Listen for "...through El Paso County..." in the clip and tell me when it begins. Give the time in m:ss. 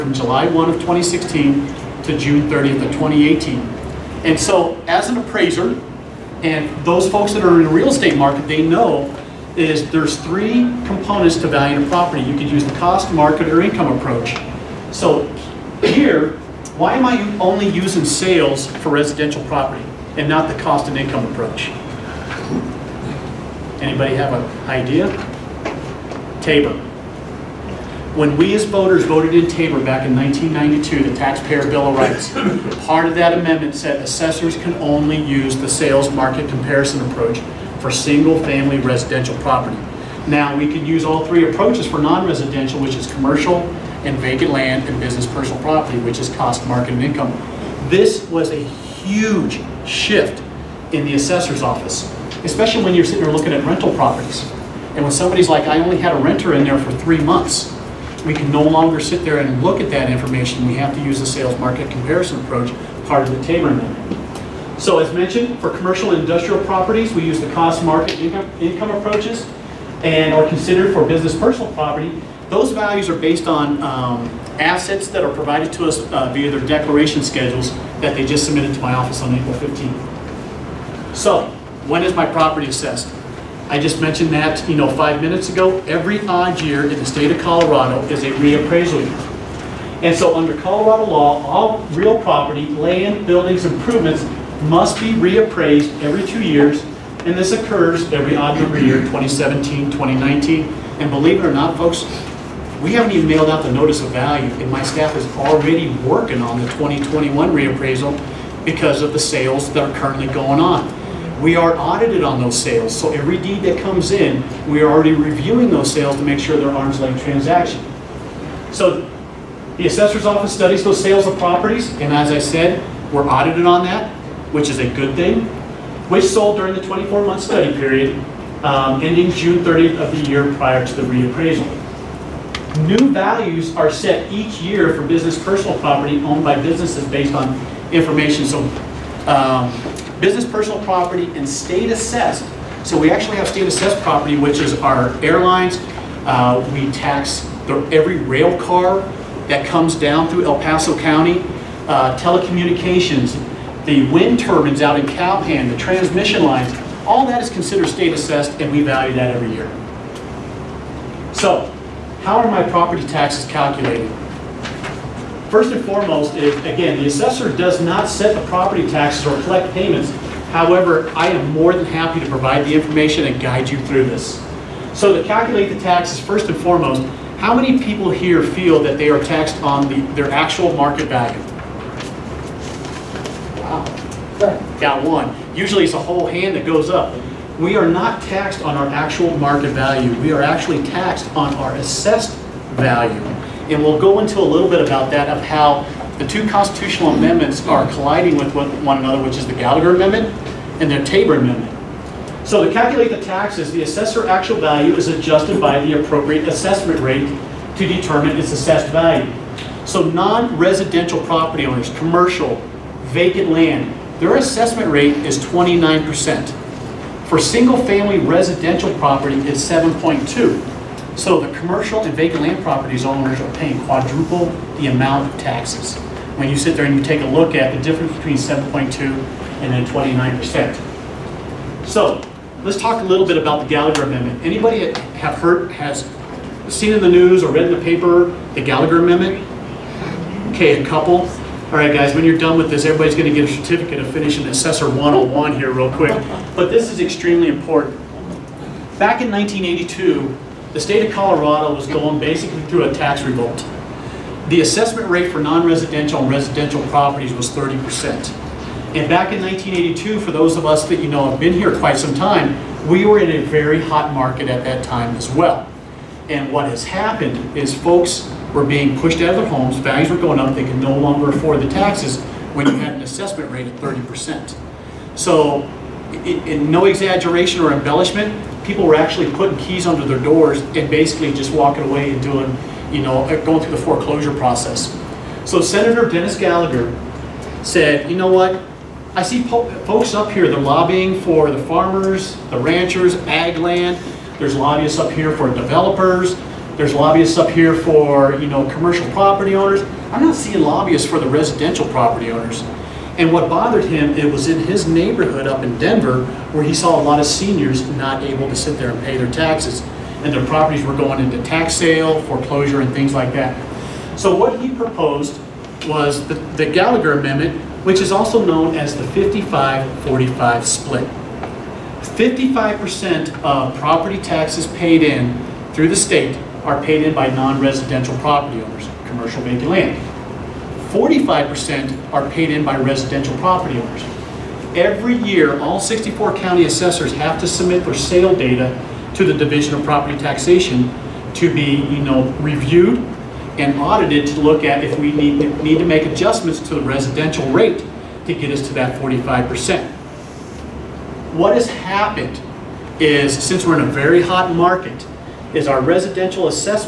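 2:30.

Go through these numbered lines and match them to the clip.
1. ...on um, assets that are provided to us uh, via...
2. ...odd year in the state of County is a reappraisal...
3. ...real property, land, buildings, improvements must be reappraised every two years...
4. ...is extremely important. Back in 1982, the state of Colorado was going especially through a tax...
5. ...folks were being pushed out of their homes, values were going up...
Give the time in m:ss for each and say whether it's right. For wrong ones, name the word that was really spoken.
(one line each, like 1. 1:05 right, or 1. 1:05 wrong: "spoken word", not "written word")
1. 1:13 right
2. 1:26 wrong: "Colorado", not "County"
3. 1:31 right
4. 4:06 wrong: "basically", not "especially"
5. 4:27 right.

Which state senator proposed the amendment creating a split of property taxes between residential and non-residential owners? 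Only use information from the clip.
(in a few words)
Dennis Gallagher.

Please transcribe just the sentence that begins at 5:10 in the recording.
And their properties were going into tax sale, foreclosure, and things like that.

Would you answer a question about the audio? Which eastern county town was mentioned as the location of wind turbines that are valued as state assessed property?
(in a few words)
Calhan.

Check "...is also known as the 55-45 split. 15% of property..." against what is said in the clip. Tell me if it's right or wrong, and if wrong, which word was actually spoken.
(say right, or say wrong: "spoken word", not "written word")
wrong: "55", not "15".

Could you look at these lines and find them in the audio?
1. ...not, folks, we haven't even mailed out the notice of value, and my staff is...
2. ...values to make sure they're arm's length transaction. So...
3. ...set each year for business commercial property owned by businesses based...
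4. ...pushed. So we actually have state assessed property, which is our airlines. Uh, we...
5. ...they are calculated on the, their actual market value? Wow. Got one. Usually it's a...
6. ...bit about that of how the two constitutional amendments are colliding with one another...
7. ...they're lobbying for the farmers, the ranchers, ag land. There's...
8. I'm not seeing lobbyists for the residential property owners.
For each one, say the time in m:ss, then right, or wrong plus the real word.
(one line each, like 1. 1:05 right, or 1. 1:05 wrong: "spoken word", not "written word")
1. 1:41 right
2. 1:55 wrong: "sales", not "values"
3. 2:13 wrong: "personal", not "commercial"
4. 2:21 wrong: "assessed", not "pushed"
5. 2:58 wrong: "taxed", not "calculated"
6. 3:14 right
7. 4:50 right
8. 5:00 right.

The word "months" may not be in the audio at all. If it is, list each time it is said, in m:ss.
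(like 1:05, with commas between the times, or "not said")
0:57, 2:06.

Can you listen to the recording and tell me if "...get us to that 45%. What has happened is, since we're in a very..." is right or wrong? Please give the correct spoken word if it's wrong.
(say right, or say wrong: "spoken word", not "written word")
right.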